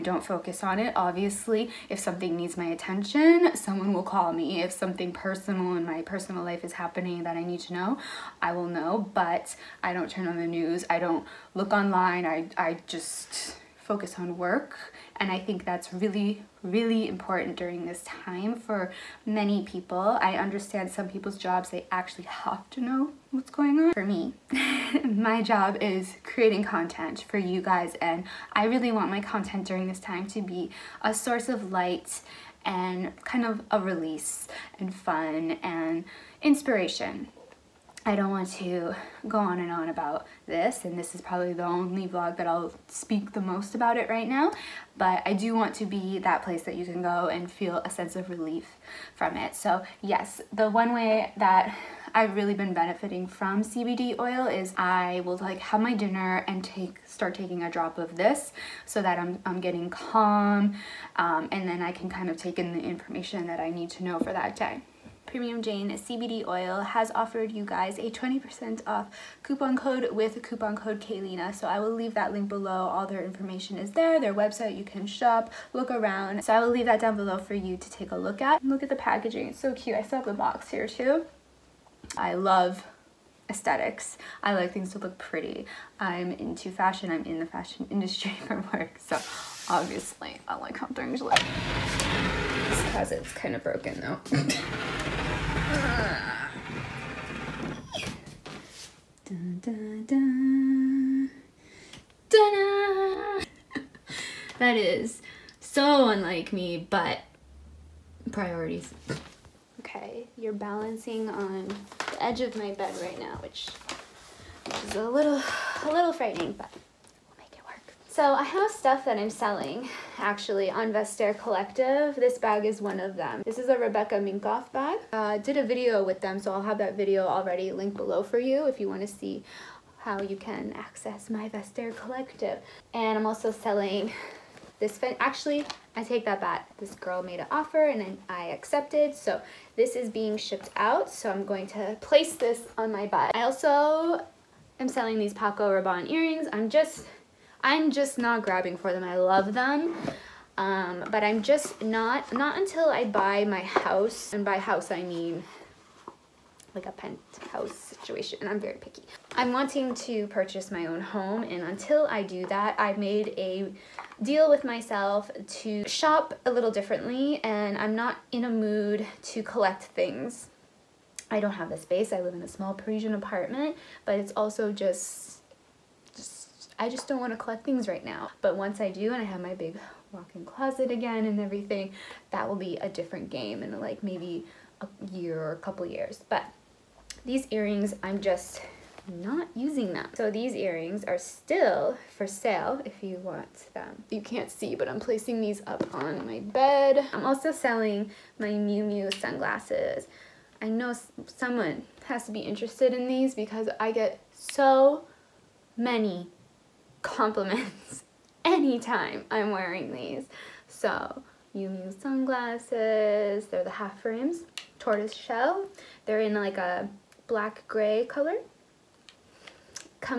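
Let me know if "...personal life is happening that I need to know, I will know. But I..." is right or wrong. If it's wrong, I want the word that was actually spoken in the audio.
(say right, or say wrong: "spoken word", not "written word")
right.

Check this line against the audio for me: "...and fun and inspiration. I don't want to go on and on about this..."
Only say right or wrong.
right.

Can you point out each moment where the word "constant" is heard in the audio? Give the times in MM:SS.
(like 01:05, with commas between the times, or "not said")
not said.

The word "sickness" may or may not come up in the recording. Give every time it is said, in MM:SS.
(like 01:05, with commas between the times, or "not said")
not said.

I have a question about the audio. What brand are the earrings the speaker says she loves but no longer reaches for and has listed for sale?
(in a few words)
Paco Rabanne.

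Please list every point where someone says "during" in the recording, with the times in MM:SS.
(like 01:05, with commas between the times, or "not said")
00:17, 00:29.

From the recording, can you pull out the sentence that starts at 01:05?
Premium Jane CBD oil has offered you guys a 20% off coupon code with coupon code Kayleena.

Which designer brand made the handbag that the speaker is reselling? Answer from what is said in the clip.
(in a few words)
Rebecca Minkoff.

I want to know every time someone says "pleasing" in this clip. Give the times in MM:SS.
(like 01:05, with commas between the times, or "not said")
not said.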